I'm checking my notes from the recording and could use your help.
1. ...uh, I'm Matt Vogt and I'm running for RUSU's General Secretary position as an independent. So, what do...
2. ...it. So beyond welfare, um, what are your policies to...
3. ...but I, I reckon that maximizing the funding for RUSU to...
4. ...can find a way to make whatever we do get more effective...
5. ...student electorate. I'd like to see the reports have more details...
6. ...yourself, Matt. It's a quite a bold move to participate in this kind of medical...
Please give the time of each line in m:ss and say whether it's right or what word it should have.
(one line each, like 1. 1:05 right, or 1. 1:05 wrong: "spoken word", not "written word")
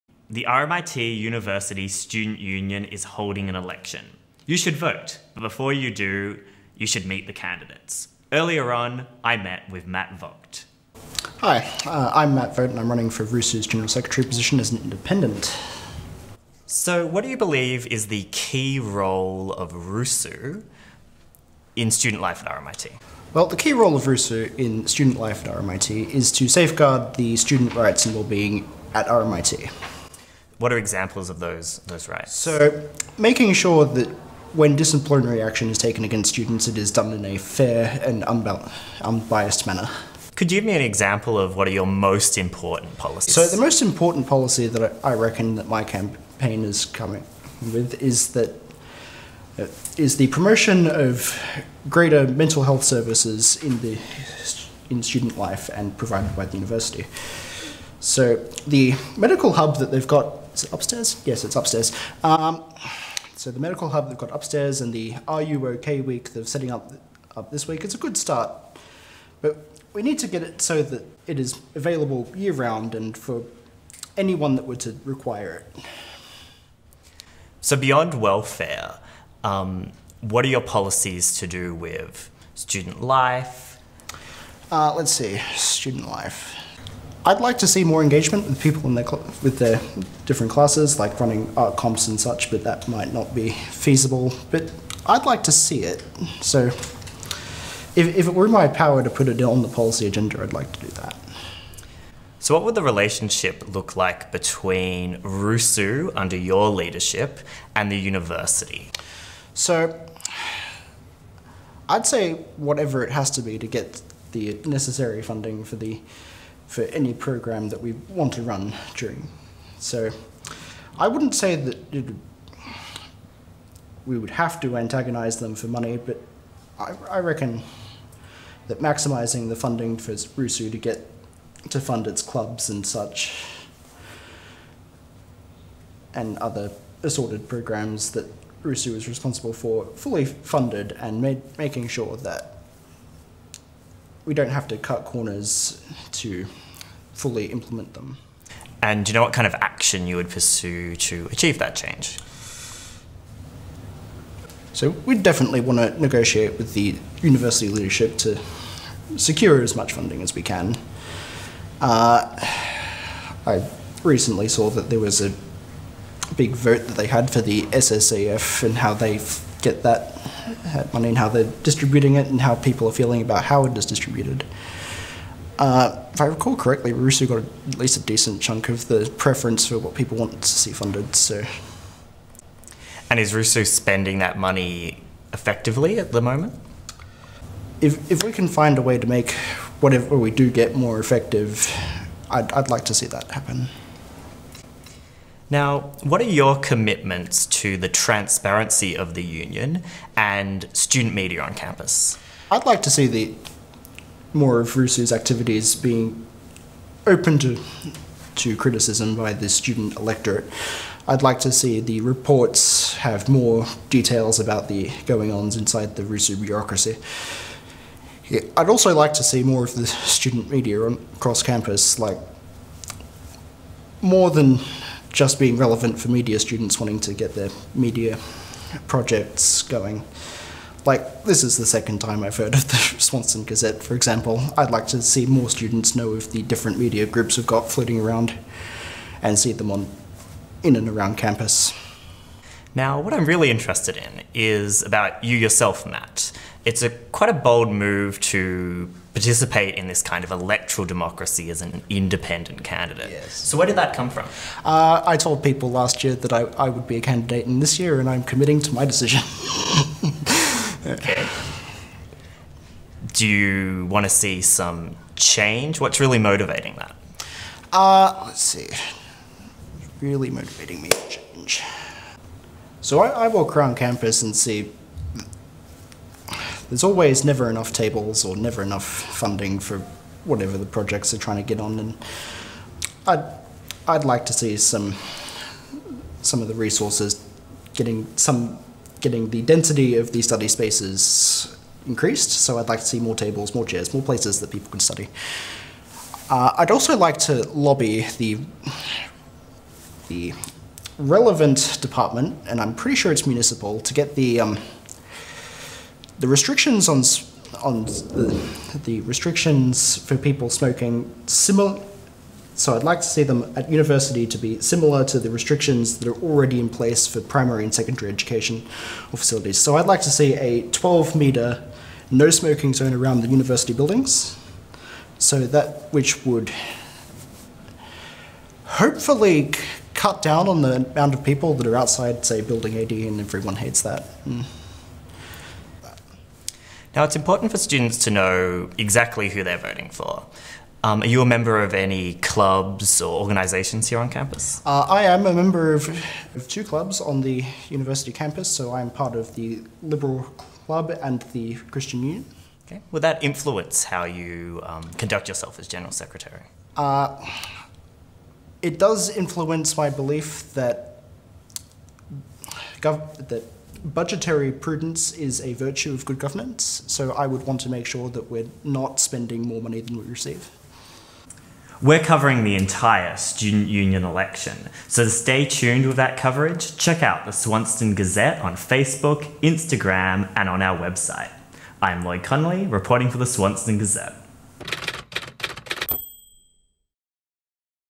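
1. 0:11 right
2. 1:15 right
3. 2:05 right
4. 3:08 right
5. 3:29 right
6. 4:05 wrong: "electoral", not "medical".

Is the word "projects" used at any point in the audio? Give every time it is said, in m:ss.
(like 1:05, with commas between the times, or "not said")
3:48, 4:40.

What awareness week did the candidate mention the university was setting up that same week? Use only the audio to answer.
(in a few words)
Are You OK week.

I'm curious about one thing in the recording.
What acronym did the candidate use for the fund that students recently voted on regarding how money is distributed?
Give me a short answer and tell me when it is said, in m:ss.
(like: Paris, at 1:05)
SSAF, at 2:47.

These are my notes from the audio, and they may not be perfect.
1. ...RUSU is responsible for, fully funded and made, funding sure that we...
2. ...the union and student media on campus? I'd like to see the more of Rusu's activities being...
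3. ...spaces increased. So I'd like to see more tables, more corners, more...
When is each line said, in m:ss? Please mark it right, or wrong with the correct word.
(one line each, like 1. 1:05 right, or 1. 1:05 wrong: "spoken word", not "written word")
1. 2:18 wrong: "making", not "funding"
2. 3:19 right
3. 4:50 wrong: "chairs", not "corners".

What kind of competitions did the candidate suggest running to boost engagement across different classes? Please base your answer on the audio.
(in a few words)
art comps.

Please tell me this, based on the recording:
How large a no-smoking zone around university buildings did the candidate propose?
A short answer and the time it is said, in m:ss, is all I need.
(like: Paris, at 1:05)
12 metres, at 5:20.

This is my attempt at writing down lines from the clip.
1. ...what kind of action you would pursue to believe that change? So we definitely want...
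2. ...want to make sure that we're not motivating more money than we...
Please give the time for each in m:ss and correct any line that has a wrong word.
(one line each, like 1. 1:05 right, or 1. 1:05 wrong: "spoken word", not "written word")
1. 2:29 wrong: "achieve", not "believe"
2. 6:07 wrong: "spending", not "motivating".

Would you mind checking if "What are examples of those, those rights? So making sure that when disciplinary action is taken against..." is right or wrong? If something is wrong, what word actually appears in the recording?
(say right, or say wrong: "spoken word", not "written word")
right.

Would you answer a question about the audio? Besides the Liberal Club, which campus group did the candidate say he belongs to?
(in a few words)
Christian Union.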